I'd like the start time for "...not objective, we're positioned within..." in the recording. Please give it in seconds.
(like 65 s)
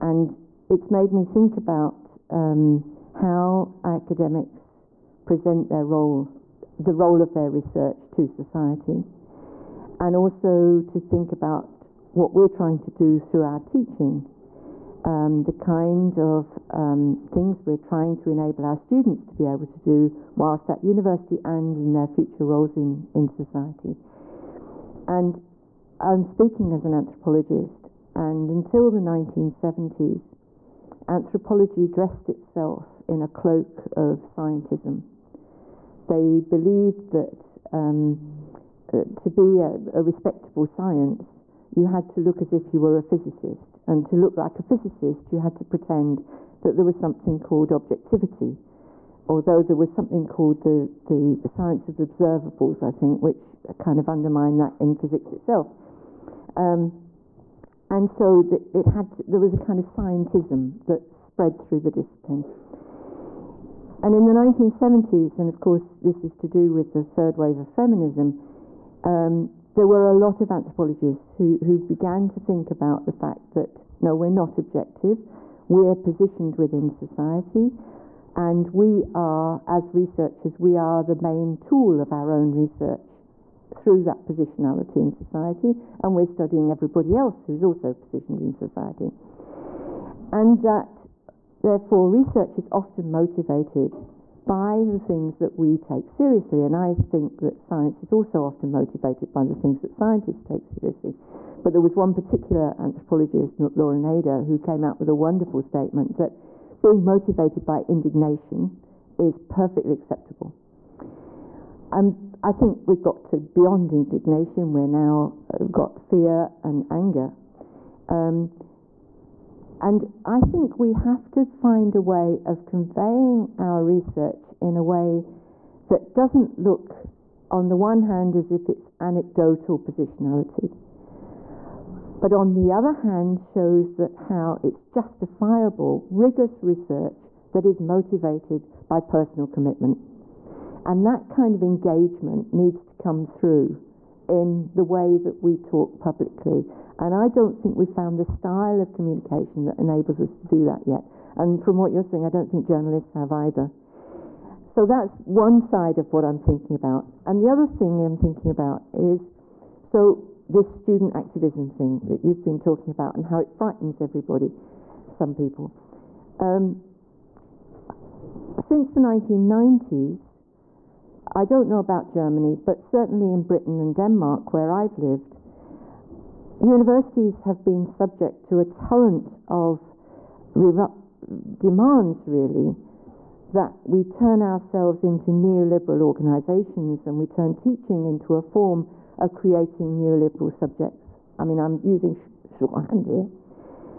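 74 s.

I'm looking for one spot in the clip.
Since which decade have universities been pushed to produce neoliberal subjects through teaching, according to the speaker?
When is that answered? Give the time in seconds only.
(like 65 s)
168 s.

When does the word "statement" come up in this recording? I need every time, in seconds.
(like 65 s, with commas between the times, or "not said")
105 s.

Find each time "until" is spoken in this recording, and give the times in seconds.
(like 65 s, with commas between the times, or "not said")
28 s.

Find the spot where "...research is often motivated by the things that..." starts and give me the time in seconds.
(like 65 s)
92 s.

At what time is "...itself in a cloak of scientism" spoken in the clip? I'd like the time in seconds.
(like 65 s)
32 s.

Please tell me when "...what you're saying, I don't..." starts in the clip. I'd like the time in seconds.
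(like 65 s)
151 s.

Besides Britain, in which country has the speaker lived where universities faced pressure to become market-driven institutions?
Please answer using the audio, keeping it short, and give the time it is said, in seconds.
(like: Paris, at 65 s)
Denmark, at 173 s.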